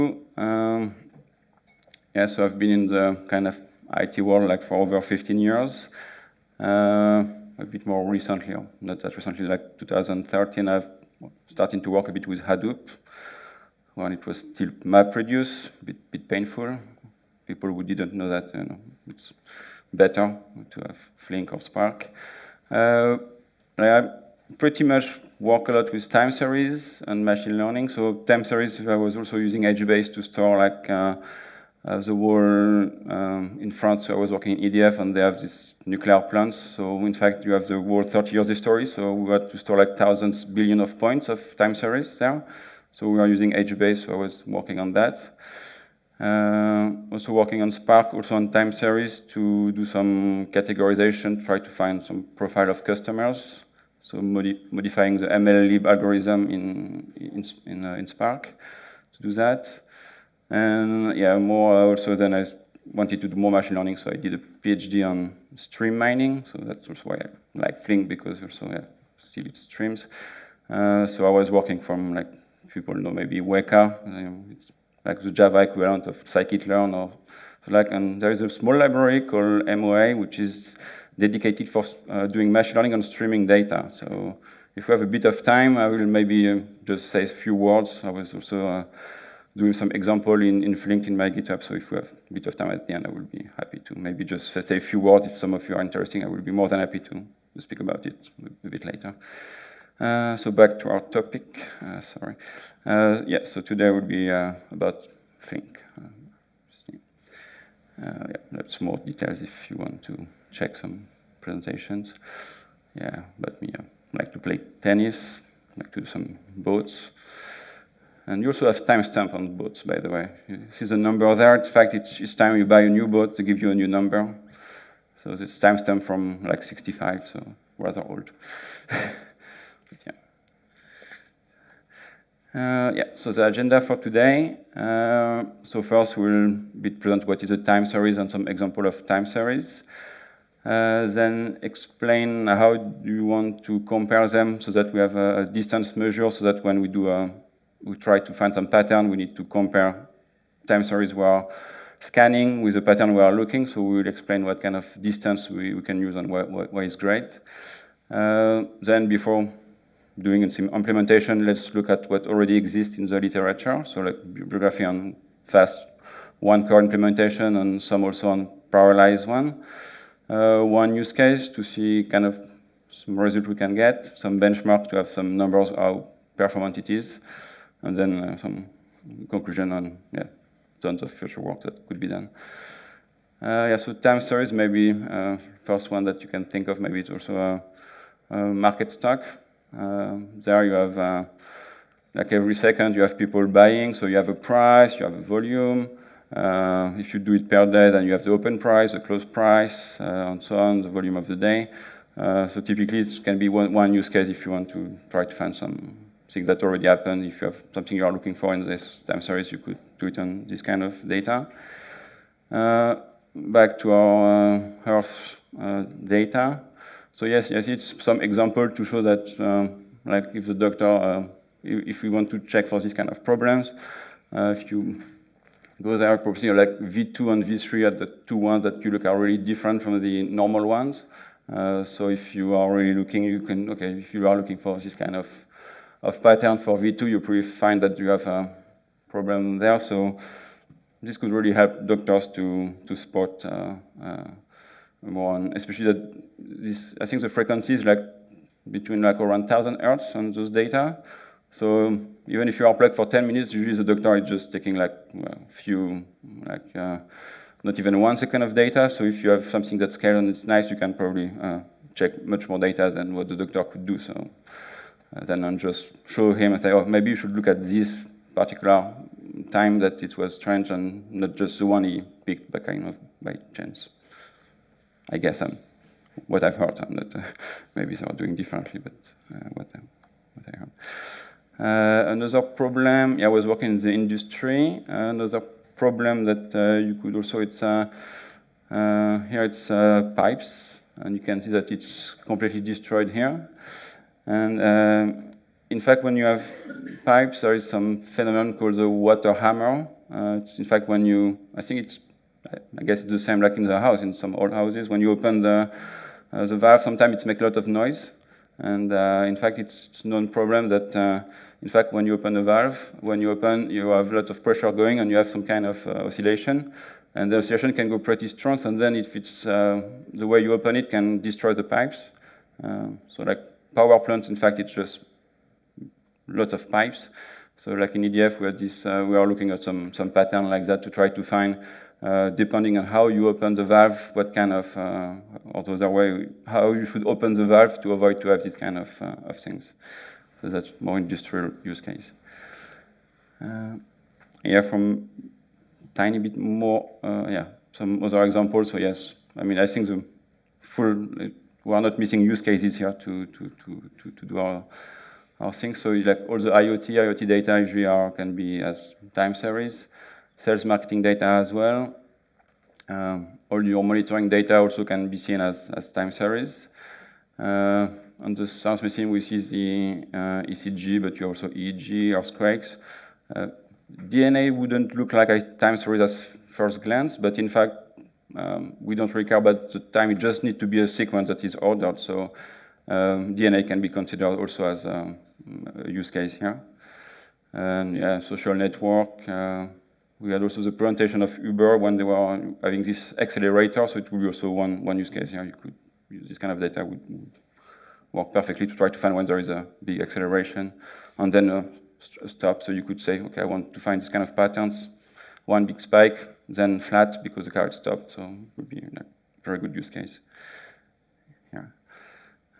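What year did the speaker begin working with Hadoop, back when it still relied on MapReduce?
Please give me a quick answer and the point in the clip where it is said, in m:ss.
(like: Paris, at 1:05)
2013, at 0:09.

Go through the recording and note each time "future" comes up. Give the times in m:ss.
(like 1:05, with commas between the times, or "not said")
3:01.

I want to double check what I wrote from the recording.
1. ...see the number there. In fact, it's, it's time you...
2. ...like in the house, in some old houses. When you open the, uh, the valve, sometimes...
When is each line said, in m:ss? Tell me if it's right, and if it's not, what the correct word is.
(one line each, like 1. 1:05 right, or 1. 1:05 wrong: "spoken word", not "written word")
1. 2:00 right
2. 5:03 right.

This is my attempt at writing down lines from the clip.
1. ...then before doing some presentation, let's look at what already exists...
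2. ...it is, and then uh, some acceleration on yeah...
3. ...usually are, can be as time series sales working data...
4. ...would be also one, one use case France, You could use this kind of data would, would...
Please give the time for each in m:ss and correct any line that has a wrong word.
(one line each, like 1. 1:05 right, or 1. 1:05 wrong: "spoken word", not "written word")
1. 2:38 wrong: "implementation", not "presentation"
2. 2:56 wrong: "conclusion", not "acceleration"
3. 5:57 wrong: "marketing", not "working"
4. 6:34 wrong: "Yeah", not "France".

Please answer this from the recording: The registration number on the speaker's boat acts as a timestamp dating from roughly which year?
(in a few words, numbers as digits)
65.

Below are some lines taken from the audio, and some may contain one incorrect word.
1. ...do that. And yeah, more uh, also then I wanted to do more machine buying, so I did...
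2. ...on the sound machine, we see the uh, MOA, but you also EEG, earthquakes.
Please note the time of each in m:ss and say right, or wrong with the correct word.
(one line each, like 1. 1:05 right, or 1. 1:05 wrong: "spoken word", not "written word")
1. 0:59 wrong: "learning", not "buying"
2. 6:08 wrong: "ECG", not "MOA".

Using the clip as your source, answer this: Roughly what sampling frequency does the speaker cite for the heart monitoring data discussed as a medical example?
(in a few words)
1000 hertz.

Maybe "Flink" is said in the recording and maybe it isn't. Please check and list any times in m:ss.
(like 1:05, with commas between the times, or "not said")
0:21, 1:07, 1:30, 1:45.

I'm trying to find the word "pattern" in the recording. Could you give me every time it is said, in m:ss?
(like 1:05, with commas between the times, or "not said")
2:28, 2:32, 3:56, 5:30, 6:44.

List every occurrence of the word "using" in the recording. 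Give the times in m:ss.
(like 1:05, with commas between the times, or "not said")
0:29, 0:43.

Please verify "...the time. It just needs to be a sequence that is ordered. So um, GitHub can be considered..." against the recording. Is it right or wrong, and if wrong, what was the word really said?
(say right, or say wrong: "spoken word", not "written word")
wrong: "DNA", not "GitHub".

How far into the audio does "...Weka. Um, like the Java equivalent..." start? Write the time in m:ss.
1:13.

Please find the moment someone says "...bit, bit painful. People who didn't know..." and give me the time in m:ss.
0:15.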